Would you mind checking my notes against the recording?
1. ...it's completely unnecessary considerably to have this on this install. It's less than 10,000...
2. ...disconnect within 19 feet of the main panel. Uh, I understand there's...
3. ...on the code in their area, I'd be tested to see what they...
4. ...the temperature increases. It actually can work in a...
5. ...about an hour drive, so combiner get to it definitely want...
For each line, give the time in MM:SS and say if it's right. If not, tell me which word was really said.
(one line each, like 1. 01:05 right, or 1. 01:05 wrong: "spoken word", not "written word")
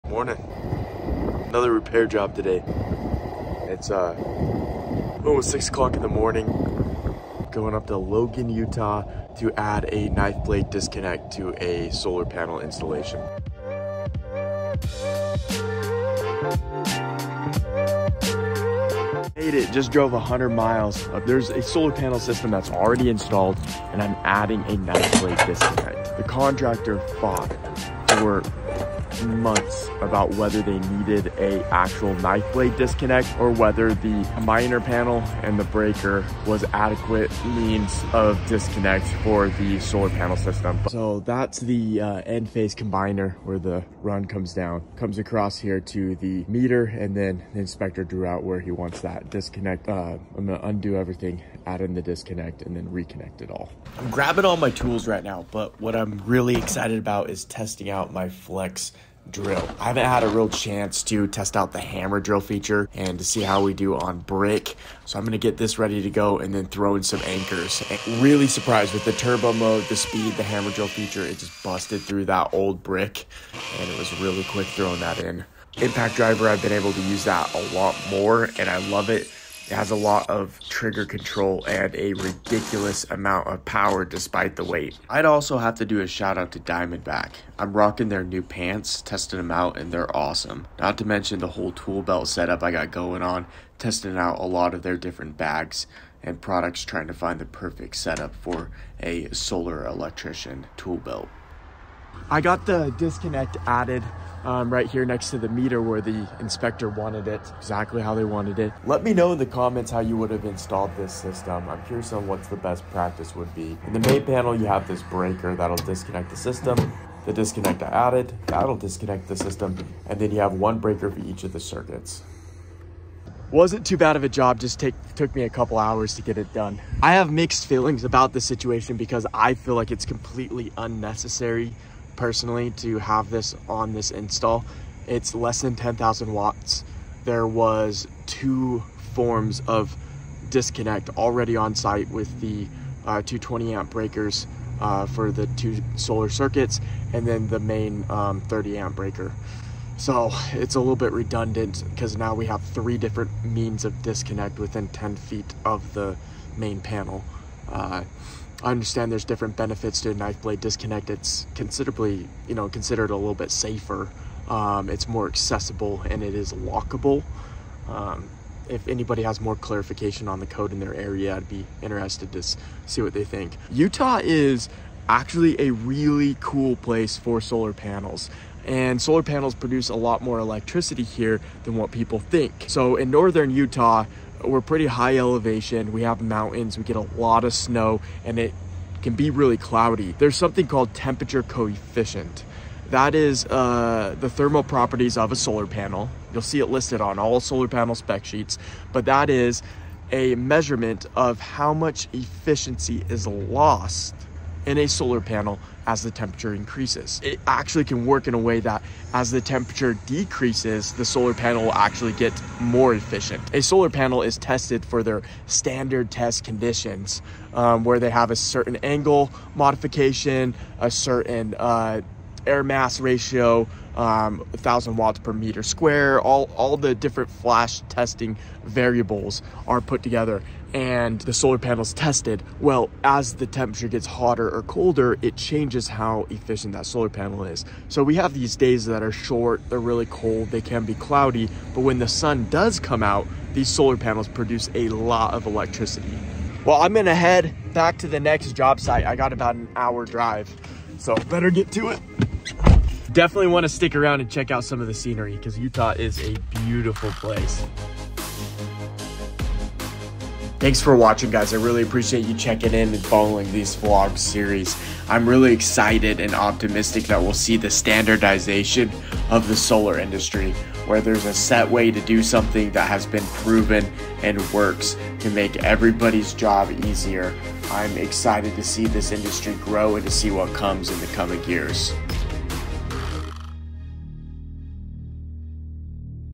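1. 02:09 wrong: "personally", not "considerably"
2. 02:34 wrong: "10", not "19"
3. 02:50 wrong: "interested", not "tested"
4. 03:26 right
5. 04:09 wrong: "better", not "combiner".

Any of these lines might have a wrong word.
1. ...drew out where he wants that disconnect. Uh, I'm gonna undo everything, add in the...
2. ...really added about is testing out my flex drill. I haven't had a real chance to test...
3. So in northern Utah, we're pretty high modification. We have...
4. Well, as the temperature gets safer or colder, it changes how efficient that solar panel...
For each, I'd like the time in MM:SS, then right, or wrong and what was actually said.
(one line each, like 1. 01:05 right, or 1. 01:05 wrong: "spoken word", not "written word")
1. 00:48 right
2. 00:56 wrong: "excited", not "added"
3. 03:02 wrong: "elevation", not "modification"
4. 03:52 wrong: "hotter", not "safer".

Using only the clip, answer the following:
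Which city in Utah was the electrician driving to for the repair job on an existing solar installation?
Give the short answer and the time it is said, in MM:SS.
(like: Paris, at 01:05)
Logan, at 00:07.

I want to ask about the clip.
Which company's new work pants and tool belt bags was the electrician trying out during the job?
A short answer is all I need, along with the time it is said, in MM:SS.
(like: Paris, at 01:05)
Diamondback, at 01:26.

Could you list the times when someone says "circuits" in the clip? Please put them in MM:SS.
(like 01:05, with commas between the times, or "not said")
02:01, 02:26.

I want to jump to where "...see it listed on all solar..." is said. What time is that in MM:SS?
03:16.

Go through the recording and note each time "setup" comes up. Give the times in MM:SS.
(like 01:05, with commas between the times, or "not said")
01:32, 01:37.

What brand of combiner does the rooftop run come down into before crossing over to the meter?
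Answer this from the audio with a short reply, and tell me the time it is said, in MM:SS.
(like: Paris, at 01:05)
Enphase, at 00:42.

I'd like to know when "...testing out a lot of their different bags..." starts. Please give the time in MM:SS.
01:33.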